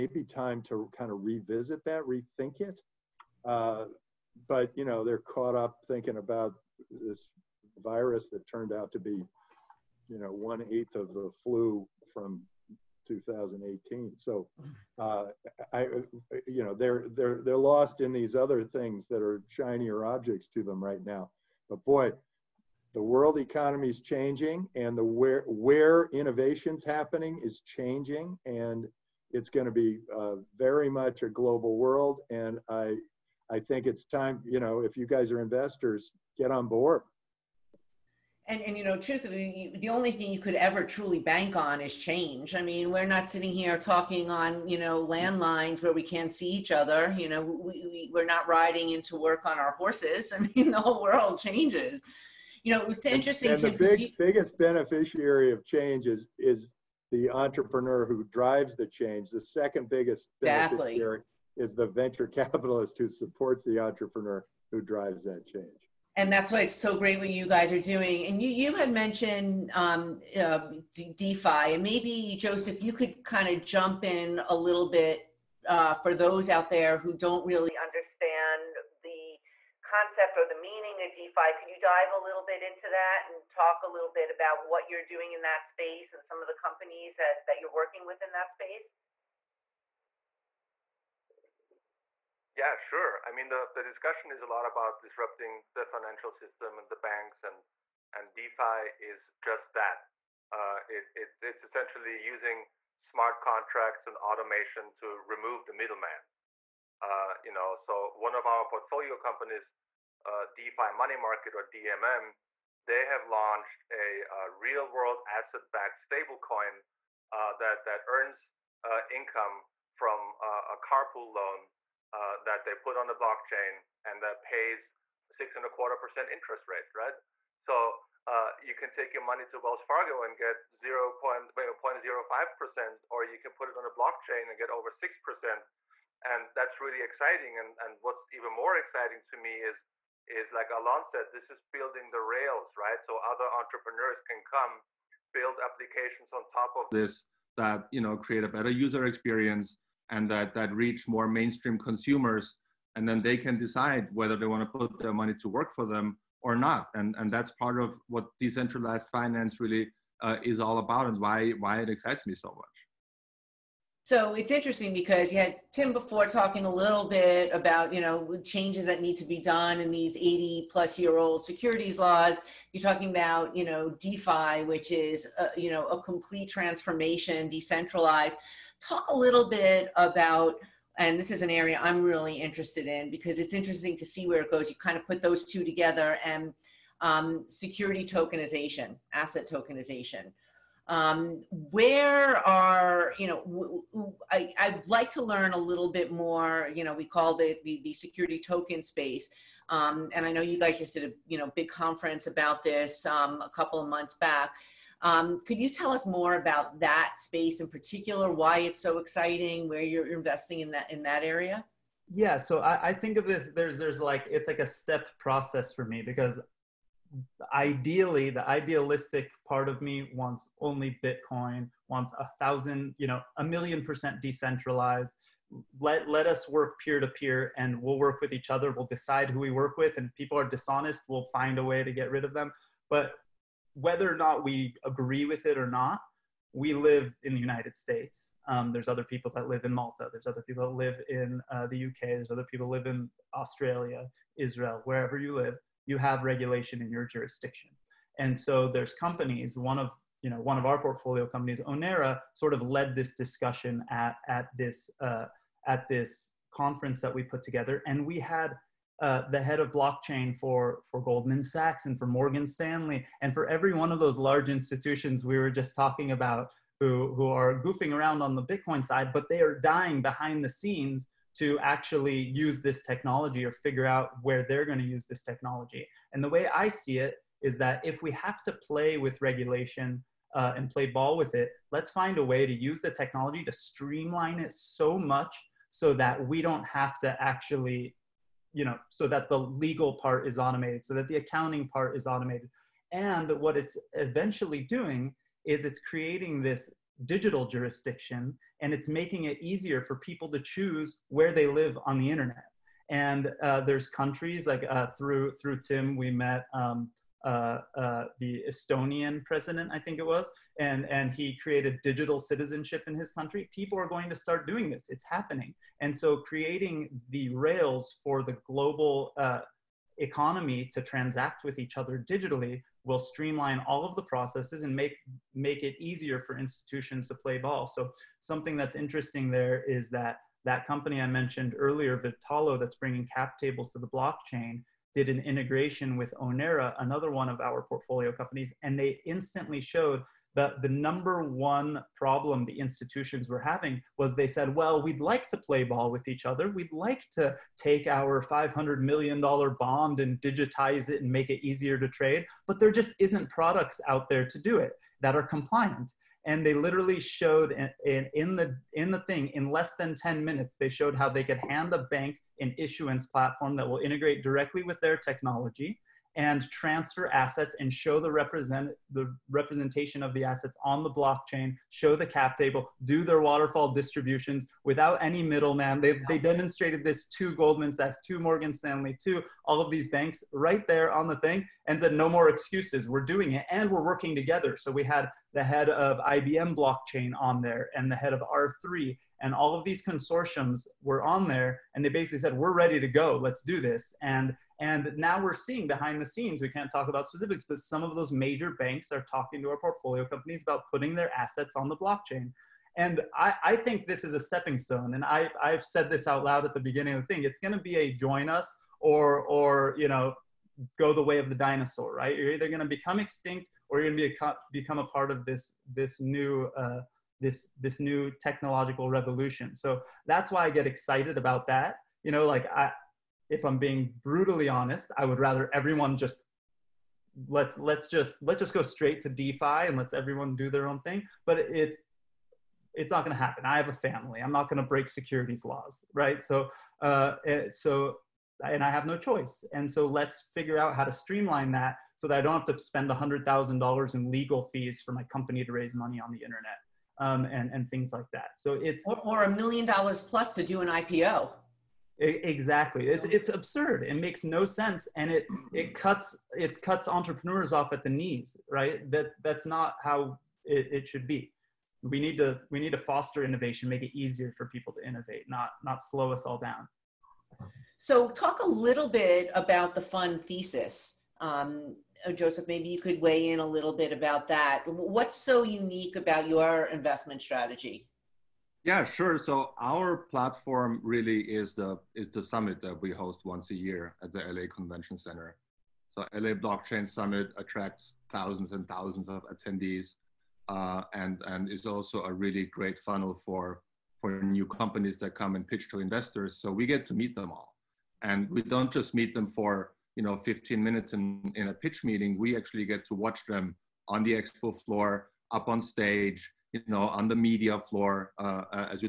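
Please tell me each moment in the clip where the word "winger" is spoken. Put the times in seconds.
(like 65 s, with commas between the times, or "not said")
not said.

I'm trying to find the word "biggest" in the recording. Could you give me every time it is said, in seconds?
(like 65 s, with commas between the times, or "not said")
54 s, 59 s.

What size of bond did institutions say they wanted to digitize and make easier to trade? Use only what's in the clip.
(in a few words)
$500 million.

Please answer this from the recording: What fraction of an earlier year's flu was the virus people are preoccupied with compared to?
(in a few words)
1/8.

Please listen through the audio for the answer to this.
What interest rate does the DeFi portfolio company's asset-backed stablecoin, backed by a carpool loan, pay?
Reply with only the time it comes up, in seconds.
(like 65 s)
125 s.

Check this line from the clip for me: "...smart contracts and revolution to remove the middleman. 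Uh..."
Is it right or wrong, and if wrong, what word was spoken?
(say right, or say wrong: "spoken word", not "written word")
wrong: "automation", not "revolution".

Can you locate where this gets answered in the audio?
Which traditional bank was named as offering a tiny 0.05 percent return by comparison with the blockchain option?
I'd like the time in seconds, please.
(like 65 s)
129 s.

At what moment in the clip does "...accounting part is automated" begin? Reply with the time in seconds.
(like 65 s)
291 s.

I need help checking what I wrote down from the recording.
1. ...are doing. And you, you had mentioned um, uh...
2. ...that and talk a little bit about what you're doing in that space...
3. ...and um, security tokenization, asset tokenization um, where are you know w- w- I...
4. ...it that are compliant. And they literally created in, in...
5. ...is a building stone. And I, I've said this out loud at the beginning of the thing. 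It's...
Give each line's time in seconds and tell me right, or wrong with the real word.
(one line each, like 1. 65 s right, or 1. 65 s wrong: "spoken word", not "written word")
1. 67 s right
2. 82 s right
3. 186 s right
4. 354 s wrong: "showed", not "created"
5. 404 s wrong: "stepping", not "building".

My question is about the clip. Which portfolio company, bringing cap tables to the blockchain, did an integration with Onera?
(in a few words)
Vertalo.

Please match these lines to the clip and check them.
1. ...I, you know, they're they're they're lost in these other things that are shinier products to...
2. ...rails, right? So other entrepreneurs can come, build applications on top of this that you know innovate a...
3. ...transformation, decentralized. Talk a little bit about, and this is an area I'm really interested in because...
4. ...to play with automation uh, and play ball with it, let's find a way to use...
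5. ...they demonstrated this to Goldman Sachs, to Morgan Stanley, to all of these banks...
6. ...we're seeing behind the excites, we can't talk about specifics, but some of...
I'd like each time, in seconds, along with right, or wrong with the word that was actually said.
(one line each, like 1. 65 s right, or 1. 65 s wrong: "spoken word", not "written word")
1. 15 s wrong: "objects", not "products"
2. 142 s wrong: "create", not "innovate"
3. 176 s right
4. 278 s wrong: "regulation", not "automation"
5. 376 s right
6. 395 s wrong: "scenes", not "excites".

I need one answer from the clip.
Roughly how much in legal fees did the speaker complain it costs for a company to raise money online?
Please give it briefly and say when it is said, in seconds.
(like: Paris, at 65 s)
$100,000, at 442 s.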